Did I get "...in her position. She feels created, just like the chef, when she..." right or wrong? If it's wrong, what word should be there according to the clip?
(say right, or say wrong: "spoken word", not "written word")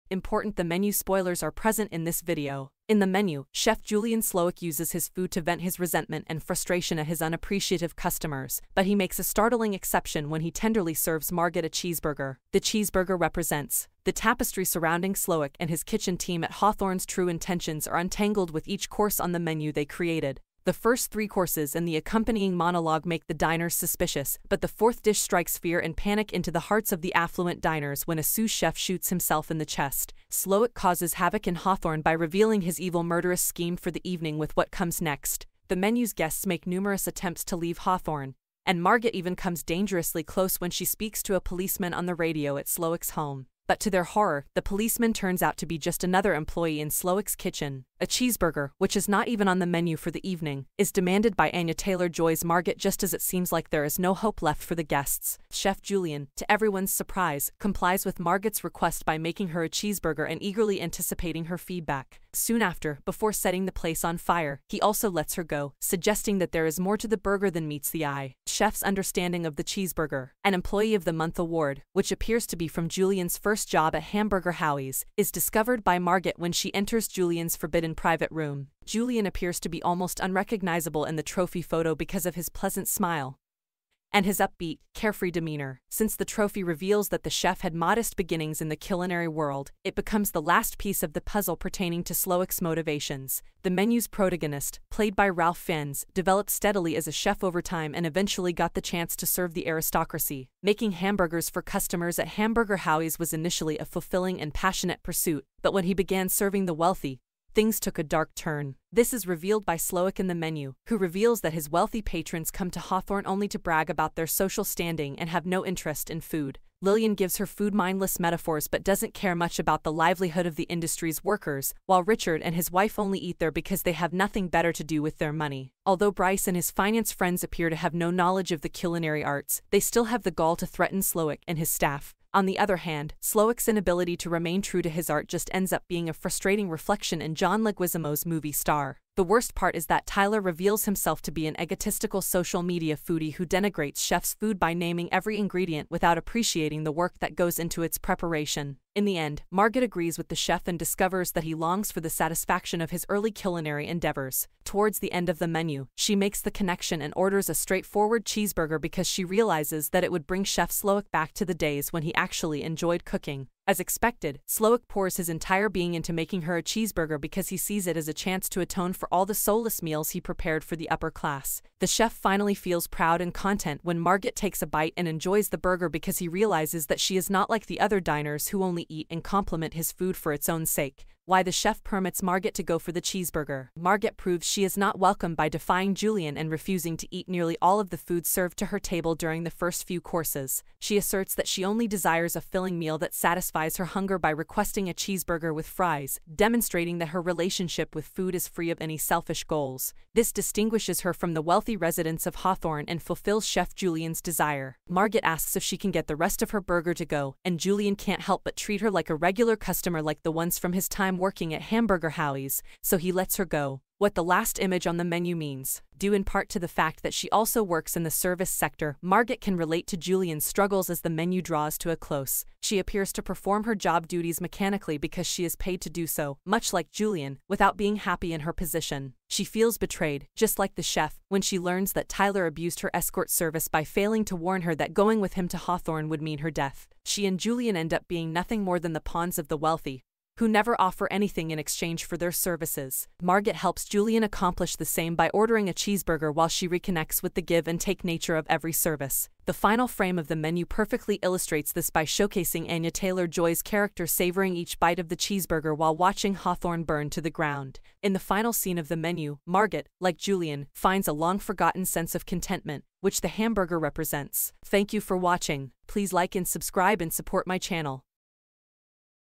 wrong: "betrayed", not "created".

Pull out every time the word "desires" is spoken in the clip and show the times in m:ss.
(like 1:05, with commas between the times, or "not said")
3:11, 3:24.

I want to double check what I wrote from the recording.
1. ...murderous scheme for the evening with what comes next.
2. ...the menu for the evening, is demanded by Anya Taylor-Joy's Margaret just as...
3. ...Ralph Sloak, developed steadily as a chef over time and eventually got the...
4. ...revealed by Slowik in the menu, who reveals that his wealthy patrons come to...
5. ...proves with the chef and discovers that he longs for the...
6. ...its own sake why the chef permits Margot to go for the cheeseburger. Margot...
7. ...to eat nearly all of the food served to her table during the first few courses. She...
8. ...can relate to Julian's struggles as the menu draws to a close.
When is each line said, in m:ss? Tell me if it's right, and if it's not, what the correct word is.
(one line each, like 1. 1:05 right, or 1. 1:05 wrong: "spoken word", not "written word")
1. 0:33 right
2. 0:49 right
3. 1:35 wrong: "Fiennes", not "Sloak"
4. 1:49 right
5. 2:29 wrong: "agrees", not "proves"
6. 3:00 right
7. 3:06 right
8. 3:39 right.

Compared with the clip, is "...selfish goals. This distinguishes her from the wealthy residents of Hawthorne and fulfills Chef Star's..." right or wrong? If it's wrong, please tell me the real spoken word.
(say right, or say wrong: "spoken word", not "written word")
wrong: "Julian", not "Star".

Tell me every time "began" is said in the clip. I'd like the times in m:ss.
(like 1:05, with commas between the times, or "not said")
1:45.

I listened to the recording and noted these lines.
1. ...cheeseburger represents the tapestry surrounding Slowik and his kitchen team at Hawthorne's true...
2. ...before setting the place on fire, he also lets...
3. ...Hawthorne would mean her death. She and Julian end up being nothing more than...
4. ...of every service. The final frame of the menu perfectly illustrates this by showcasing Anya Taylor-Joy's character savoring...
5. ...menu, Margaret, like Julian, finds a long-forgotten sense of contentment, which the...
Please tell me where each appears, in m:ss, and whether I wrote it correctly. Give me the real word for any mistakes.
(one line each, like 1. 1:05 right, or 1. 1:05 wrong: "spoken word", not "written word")
1. 0:12 right
2. 1:03 right
3. 3:55 right
4. 4:08 right
5. 4:18 right.